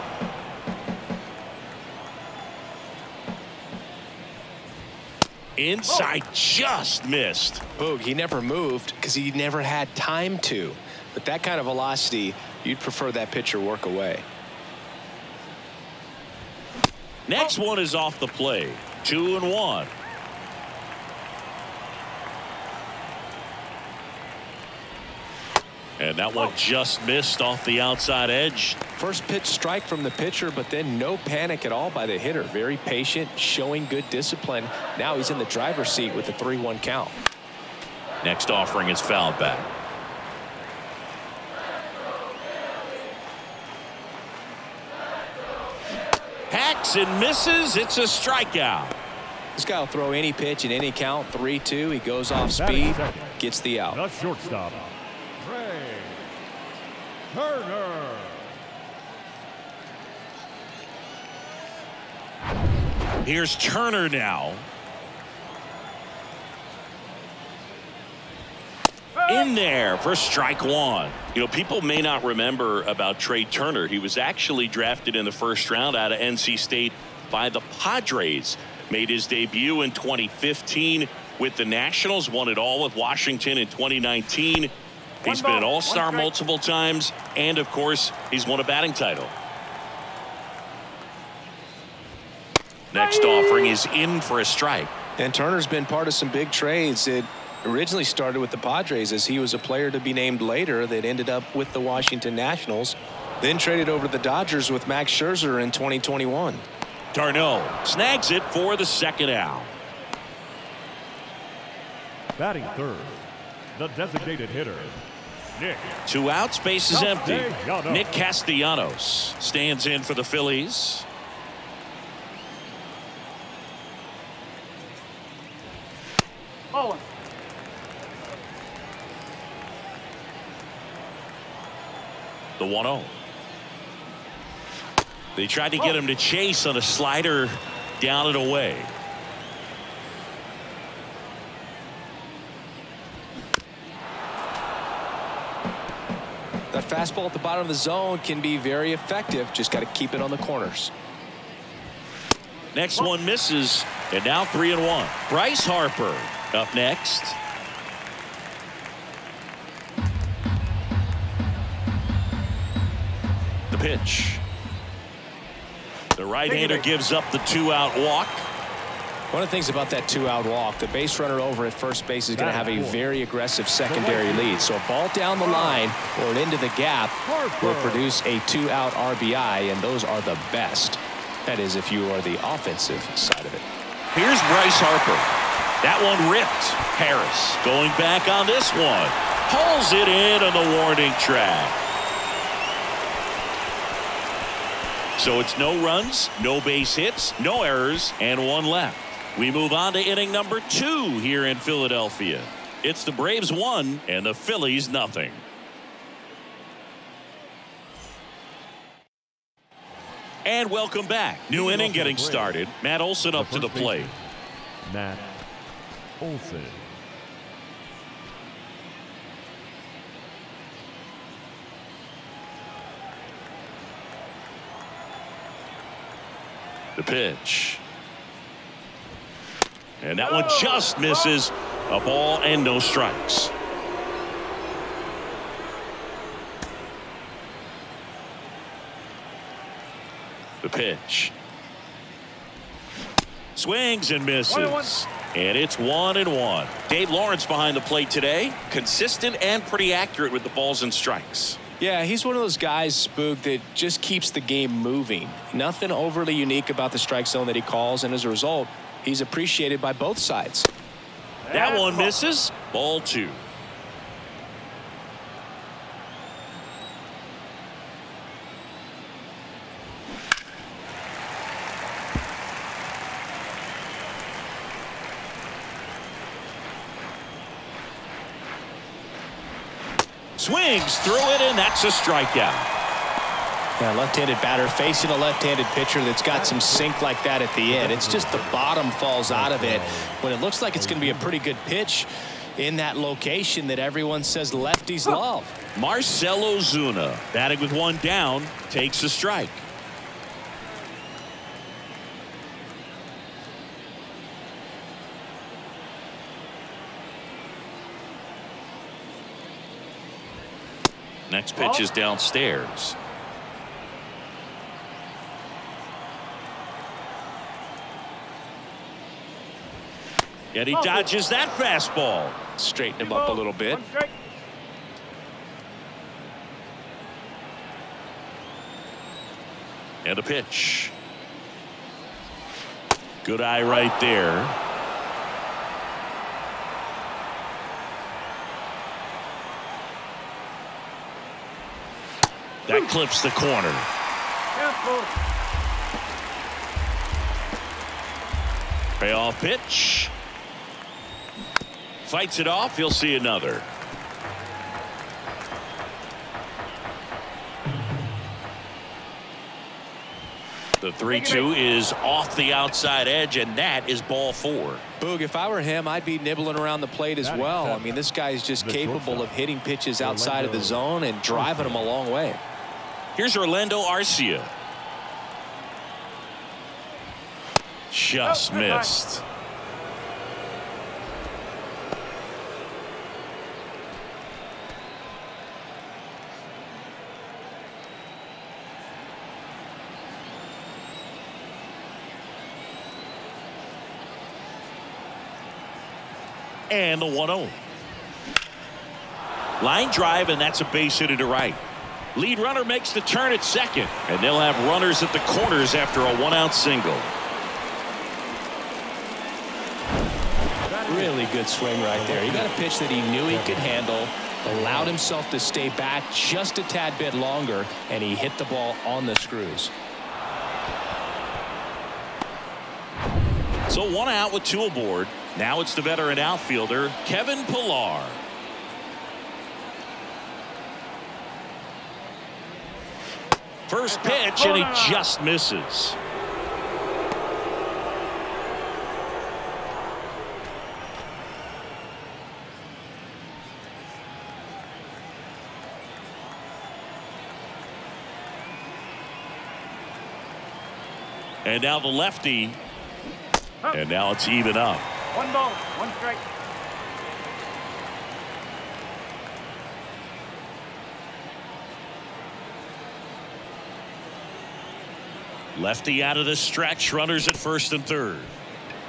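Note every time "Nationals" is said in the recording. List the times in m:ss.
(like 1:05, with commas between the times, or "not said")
1:21, 1:42.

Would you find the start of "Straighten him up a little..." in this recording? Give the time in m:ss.
5:22.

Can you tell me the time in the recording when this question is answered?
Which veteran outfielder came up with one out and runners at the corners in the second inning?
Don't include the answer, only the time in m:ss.
7:07.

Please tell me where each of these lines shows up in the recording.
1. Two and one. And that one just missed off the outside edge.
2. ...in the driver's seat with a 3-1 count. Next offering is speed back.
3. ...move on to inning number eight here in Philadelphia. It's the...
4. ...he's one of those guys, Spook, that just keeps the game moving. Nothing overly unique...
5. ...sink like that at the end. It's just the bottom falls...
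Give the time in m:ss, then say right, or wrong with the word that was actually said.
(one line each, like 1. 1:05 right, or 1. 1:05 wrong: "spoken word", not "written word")
1. 0:19 right
2. 0:35 wrong: "fouled", not "speed"
3. 3:19 wrong: "two", not "eight"
4. 4:12 right
5. 4:46 right.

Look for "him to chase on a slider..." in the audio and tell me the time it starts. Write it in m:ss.
2:15.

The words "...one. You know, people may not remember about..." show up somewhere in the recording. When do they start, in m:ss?
1:10.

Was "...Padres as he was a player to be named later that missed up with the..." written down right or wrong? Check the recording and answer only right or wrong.
wrong.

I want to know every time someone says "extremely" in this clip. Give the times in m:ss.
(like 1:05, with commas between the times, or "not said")
not said.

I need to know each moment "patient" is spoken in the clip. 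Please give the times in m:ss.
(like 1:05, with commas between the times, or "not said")
0:32.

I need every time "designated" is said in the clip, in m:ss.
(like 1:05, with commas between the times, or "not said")
1:53.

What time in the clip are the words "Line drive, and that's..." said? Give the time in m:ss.
6:39.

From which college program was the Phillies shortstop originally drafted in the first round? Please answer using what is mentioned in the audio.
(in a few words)
NC State.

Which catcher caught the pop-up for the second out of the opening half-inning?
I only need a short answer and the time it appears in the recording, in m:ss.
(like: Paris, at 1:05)
d'Arnaud, at 1:47.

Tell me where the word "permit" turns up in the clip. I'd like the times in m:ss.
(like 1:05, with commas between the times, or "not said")
not said.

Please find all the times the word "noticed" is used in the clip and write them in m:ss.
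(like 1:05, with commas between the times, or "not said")
not said.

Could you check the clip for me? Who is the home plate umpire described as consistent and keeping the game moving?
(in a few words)
Dave Lawrence.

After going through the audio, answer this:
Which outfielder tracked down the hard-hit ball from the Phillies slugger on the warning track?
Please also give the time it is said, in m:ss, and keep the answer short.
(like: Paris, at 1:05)
Harris, at 3:07.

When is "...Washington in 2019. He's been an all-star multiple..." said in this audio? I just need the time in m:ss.
1:22.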